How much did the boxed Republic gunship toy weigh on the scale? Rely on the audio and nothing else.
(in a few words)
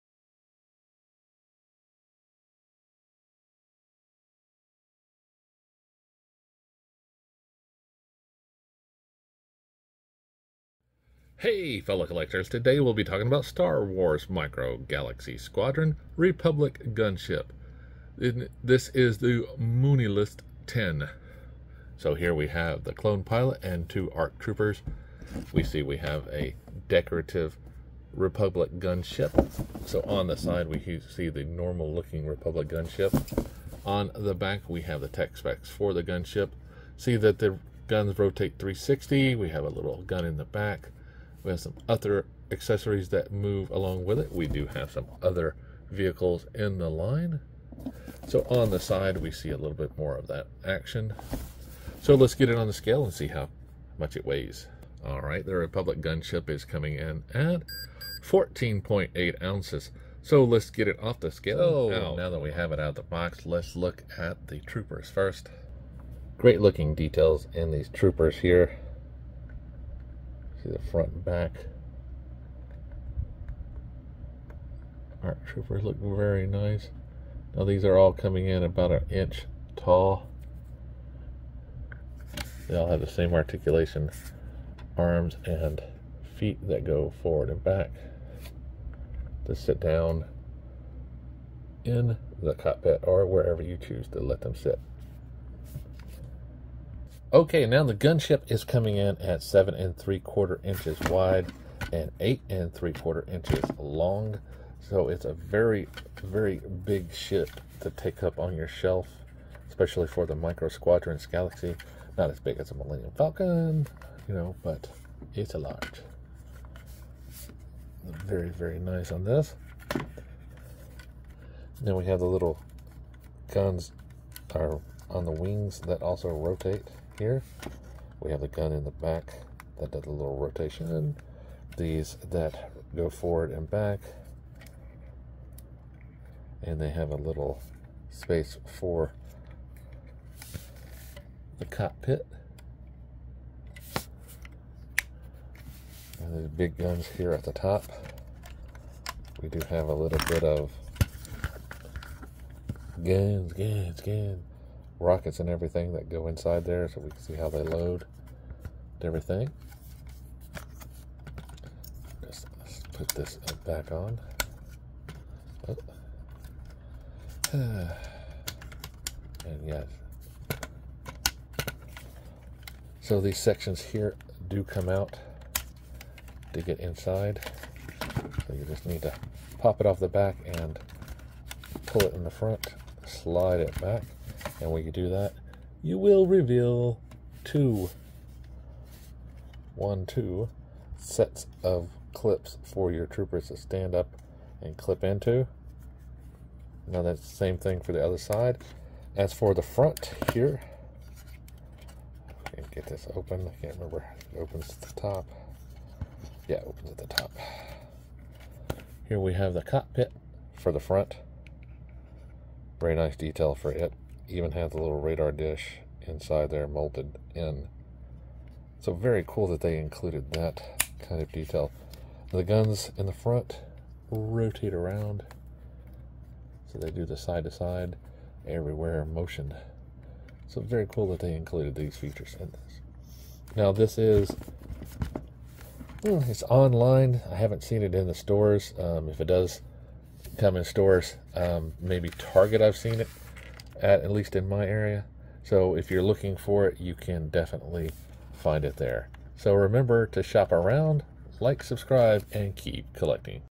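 14.8 ounces.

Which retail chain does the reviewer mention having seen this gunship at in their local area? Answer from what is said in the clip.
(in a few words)
Target.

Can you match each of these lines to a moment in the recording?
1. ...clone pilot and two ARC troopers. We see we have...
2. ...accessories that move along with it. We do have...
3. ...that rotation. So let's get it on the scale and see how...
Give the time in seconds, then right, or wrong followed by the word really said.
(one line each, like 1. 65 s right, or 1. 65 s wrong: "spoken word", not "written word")
1. 22 s right
2. 42 s right
3. 50 s wrong: "action", not "rotation".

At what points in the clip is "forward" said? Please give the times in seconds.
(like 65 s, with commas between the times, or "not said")
87 s, 133 s.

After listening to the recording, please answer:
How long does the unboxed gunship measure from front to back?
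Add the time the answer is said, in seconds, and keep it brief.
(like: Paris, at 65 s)
8 3/4 inches, at 102 s.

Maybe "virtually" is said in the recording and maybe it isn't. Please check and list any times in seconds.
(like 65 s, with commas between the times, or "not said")
not said.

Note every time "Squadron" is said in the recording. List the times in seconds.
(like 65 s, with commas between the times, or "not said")
15 s, 110 s.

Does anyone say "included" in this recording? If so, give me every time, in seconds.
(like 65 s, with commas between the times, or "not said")
219 s, 231 s.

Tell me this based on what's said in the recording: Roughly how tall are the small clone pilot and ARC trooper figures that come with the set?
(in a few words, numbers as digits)
about an inch.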